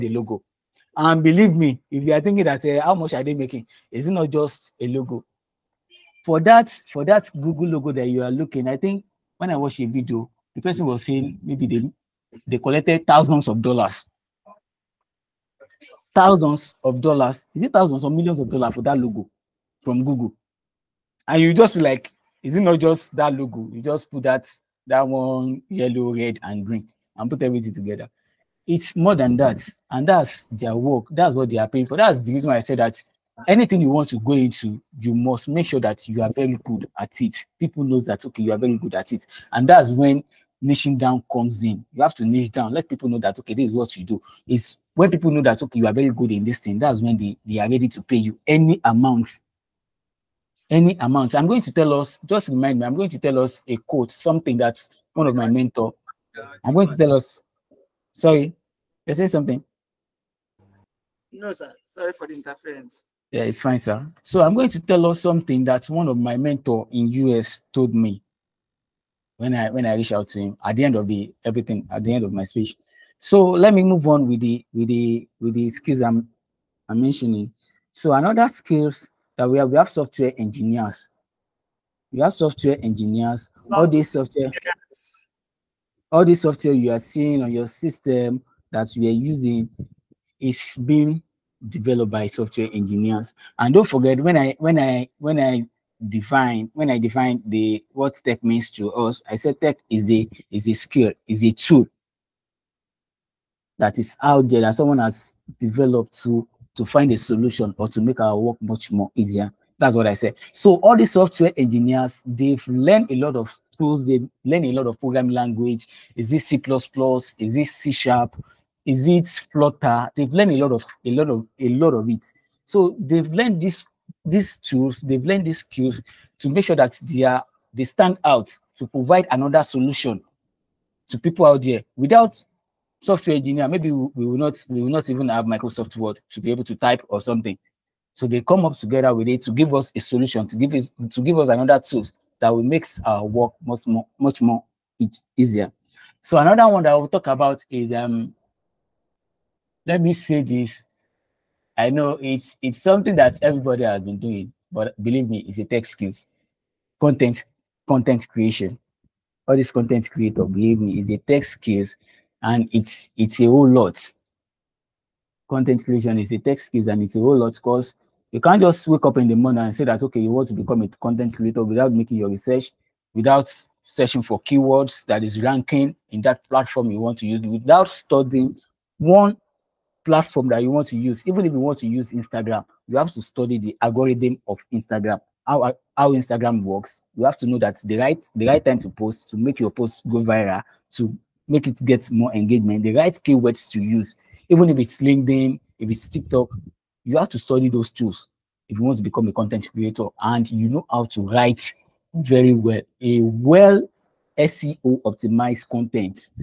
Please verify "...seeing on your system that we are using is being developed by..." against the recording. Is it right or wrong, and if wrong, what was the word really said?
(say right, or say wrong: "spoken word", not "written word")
right.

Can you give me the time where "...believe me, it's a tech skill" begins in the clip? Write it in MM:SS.
02:35.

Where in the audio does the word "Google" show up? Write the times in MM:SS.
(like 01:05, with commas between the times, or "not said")
00:07, 00:20.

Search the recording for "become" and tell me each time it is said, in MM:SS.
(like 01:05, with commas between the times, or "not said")
02:50, 03:19.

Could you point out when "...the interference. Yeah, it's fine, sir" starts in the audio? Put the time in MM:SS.
01:02.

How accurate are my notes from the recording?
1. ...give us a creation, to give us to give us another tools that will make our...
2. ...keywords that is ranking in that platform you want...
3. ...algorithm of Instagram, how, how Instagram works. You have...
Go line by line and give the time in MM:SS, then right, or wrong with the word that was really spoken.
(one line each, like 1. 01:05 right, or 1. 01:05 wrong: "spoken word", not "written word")
1. 02:19 wrong: "solution", not "creation"
2. 02:54 right
3. 03:03 right.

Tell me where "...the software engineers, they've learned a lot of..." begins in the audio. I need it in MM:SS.
01:50.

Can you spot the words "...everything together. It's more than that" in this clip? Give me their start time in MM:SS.
00:27.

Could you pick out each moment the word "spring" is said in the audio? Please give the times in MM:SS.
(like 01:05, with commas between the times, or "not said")
not said.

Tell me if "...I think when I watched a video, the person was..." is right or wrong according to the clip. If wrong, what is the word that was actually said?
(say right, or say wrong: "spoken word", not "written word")
right.